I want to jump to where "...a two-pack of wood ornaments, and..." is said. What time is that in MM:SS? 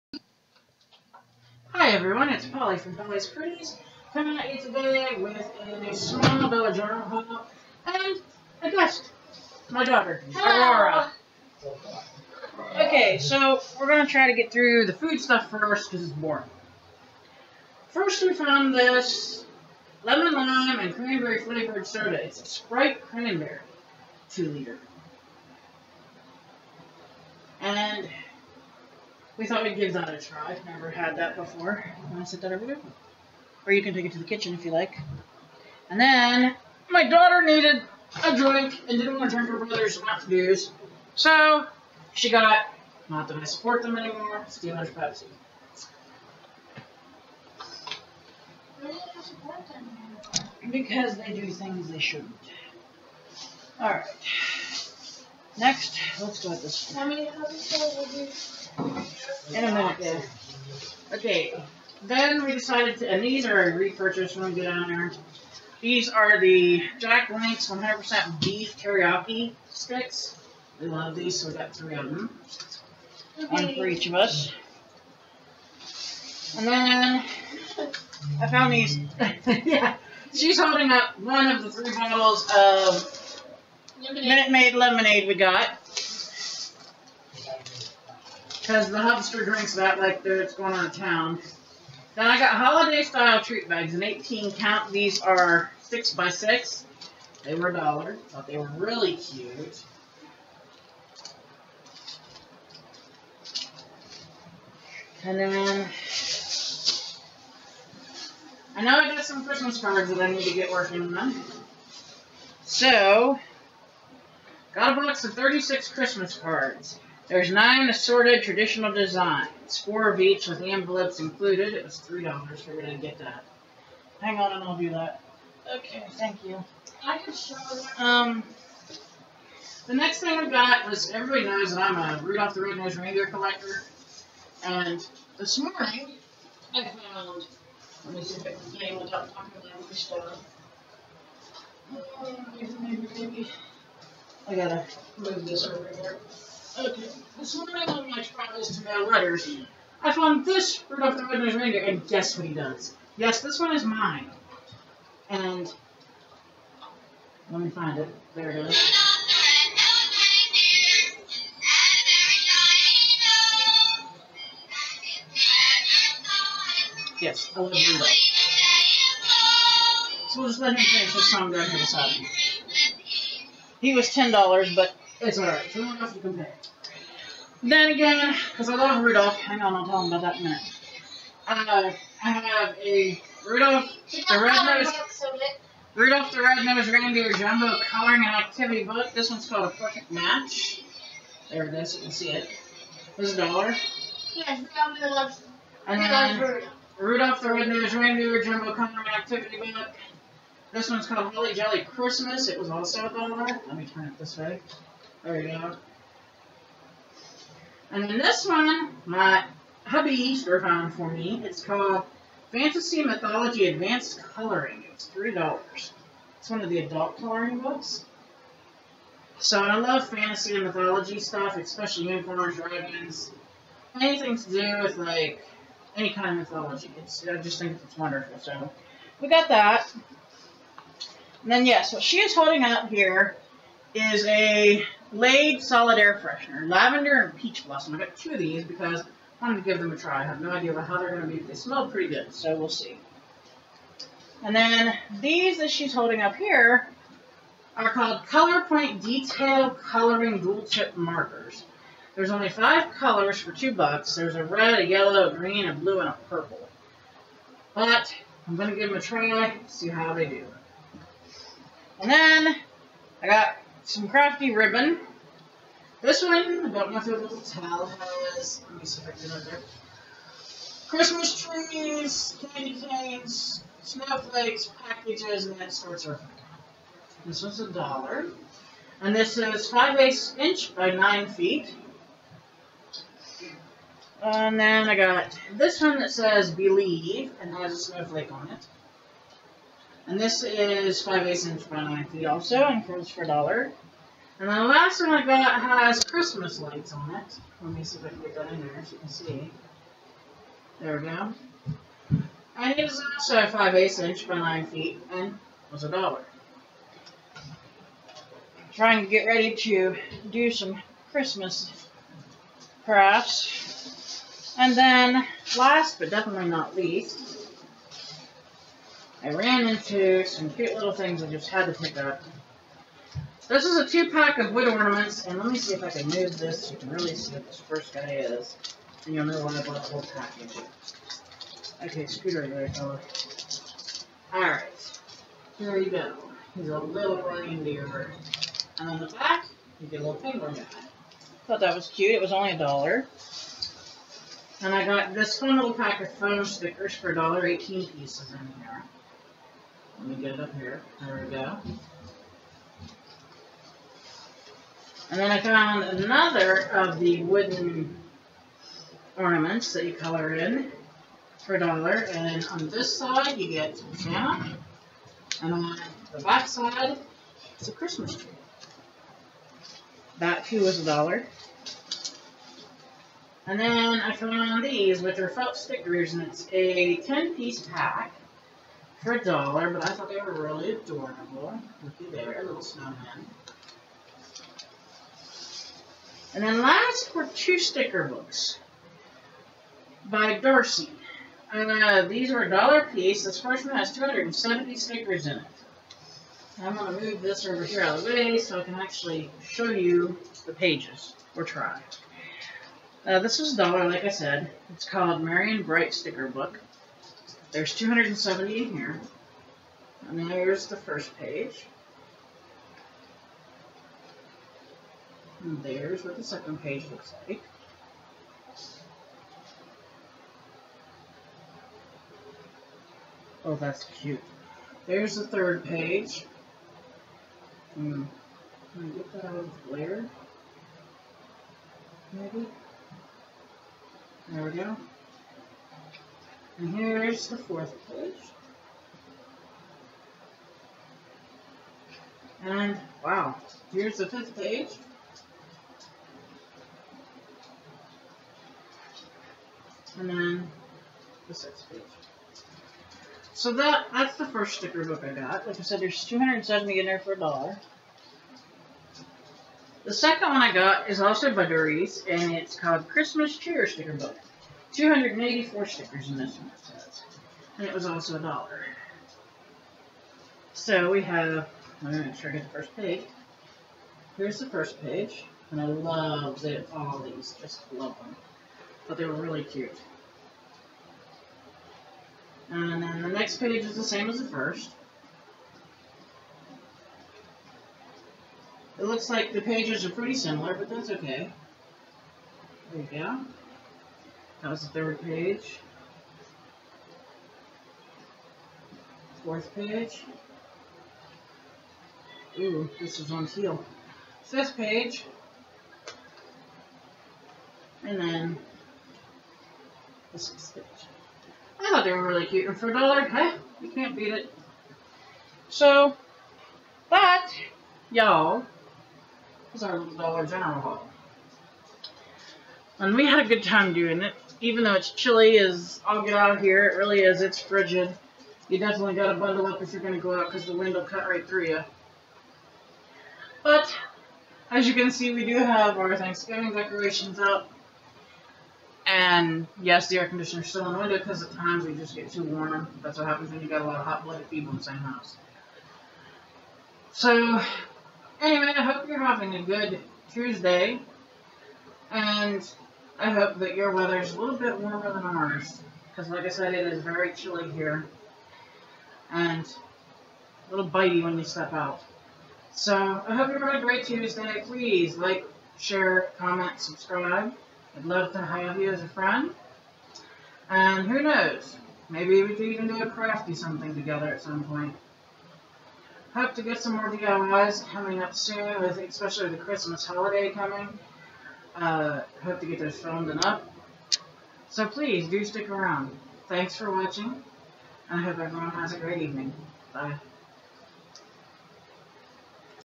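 05:23.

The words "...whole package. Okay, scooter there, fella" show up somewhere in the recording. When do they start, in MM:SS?
05:29.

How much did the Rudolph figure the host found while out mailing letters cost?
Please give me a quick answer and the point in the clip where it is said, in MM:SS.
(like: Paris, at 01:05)
$10, at 02:54.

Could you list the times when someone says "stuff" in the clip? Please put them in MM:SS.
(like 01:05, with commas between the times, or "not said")
00:15, 03:41.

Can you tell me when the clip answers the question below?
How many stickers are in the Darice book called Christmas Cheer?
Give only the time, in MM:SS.
07:44.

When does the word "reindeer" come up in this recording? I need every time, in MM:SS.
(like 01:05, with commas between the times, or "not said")
02:12, 02:31, 03:06, 03:17, 05:37.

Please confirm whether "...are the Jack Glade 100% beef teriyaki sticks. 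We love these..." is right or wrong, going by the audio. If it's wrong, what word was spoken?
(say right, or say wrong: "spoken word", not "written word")
wrong: "Links", not "Glade".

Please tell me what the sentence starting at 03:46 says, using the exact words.
It's, I just think it's wonderful.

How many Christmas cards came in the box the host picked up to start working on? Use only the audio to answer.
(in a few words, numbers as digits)
36.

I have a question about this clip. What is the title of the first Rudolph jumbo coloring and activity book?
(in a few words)
A Perfect Match.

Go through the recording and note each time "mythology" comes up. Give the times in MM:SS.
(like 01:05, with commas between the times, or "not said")
03:33, 03:40, 03:46.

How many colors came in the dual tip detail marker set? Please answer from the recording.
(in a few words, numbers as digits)
5.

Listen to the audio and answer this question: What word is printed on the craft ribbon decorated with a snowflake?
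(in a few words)
Believe.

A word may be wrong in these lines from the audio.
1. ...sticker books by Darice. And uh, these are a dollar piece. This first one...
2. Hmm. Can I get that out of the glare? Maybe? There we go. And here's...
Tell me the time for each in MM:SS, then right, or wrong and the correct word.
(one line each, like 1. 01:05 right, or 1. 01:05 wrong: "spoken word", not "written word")
1. 06:27 right
2. 07:07 right.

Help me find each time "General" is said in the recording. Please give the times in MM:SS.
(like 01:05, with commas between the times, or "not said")
00:06, 08:40.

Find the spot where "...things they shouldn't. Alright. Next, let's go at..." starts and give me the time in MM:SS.
00:51.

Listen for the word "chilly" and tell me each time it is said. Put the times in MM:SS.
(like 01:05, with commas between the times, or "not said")
08:44, 09:17.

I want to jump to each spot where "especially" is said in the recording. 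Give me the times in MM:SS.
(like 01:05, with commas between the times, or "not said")
03:41, 09:38.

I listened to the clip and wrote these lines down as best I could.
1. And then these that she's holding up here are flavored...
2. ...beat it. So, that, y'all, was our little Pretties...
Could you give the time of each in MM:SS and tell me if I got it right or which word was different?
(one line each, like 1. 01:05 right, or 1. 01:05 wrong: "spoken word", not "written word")
1. 04:04 wrong: "called", not "flavored"
2. 08:33 wrong: "Dollar", not "Pretties".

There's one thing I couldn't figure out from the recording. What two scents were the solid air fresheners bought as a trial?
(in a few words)
Lavender and Peach Blossom.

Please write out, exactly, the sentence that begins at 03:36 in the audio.
It's one of the adult coloring books.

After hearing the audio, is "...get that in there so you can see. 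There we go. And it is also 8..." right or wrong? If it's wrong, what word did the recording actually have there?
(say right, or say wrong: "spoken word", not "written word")
wrong: "5", not "8".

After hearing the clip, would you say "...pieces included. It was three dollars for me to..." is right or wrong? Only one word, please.
wrong.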